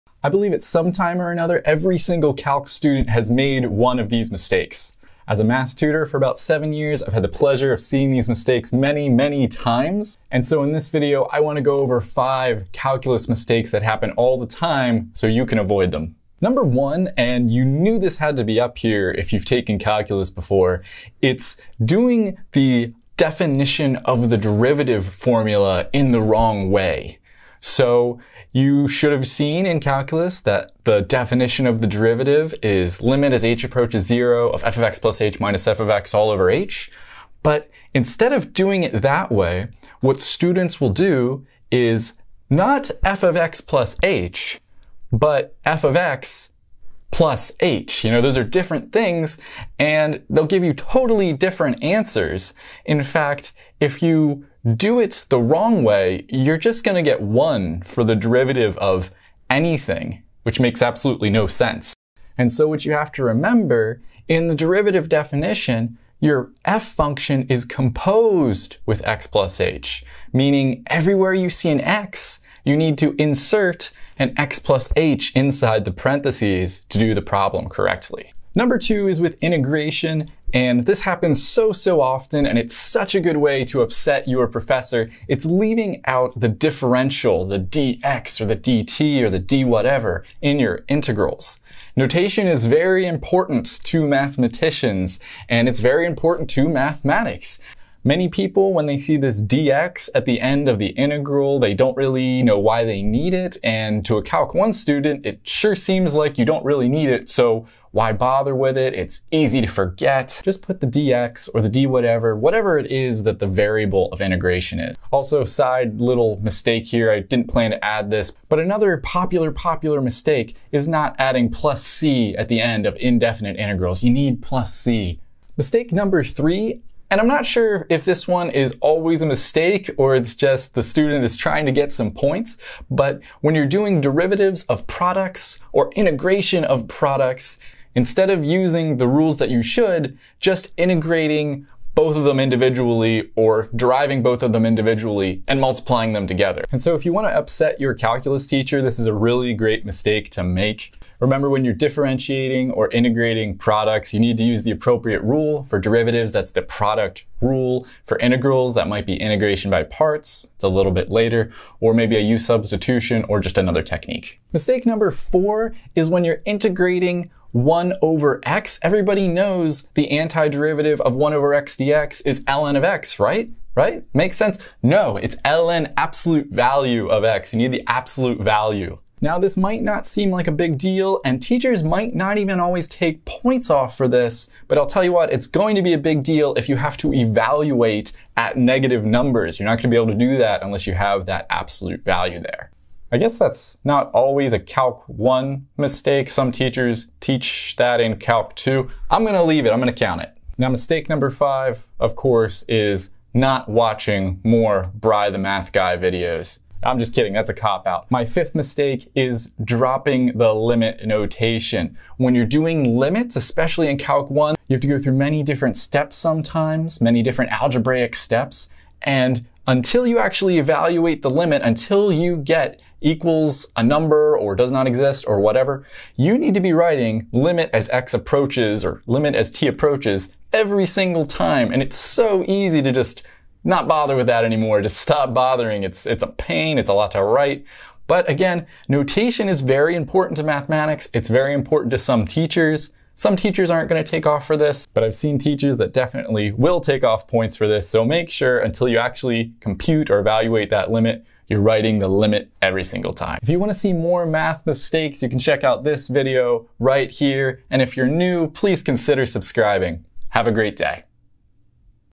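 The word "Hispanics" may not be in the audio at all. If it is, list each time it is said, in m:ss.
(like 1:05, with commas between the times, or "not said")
not said.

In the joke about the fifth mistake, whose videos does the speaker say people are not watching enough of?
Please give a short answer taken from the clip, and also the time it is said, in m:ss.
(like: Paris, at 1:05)
Bri the Math Guy, at 3:24.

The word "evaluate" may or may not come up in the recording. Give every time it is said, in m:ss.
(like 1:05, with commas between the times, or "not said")
3:07, 3:40, 4:10.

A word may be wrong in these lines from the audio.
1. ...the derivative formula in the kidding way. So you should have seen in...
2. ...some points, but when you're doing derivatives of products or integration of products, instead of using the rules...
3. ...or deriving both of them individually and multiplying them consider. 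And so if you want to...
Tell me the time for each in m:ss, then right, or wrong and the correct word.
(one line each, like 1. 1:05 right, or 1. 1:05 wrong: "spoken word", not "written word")
1. 0:24 wrong: "wrong", not "kidding"
2. 2:11 right
3. 2:23 wrong: "together", not "consider".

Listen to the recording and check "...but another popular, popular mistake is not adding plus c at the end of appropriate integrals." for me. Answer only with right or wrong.
wrong.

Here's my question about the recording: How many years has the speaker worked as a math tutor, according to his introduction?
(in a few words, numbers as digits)
7.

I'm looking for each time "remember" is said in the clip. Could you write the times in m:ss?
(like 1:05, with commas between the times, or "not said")
1:03, 2:31.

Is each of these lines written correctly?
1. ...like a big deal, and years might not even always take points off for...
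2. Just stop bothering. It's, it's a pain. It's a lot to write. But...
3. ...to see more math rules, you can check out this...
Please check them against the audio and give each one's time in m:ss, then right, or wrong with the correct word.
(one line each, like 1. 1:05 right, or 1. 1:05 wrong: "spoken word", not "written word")
1. 3:00 wrong: "teachers", not "years"
2. 3:54 right
3. 4:13 wrong: "mistakes", not "rules".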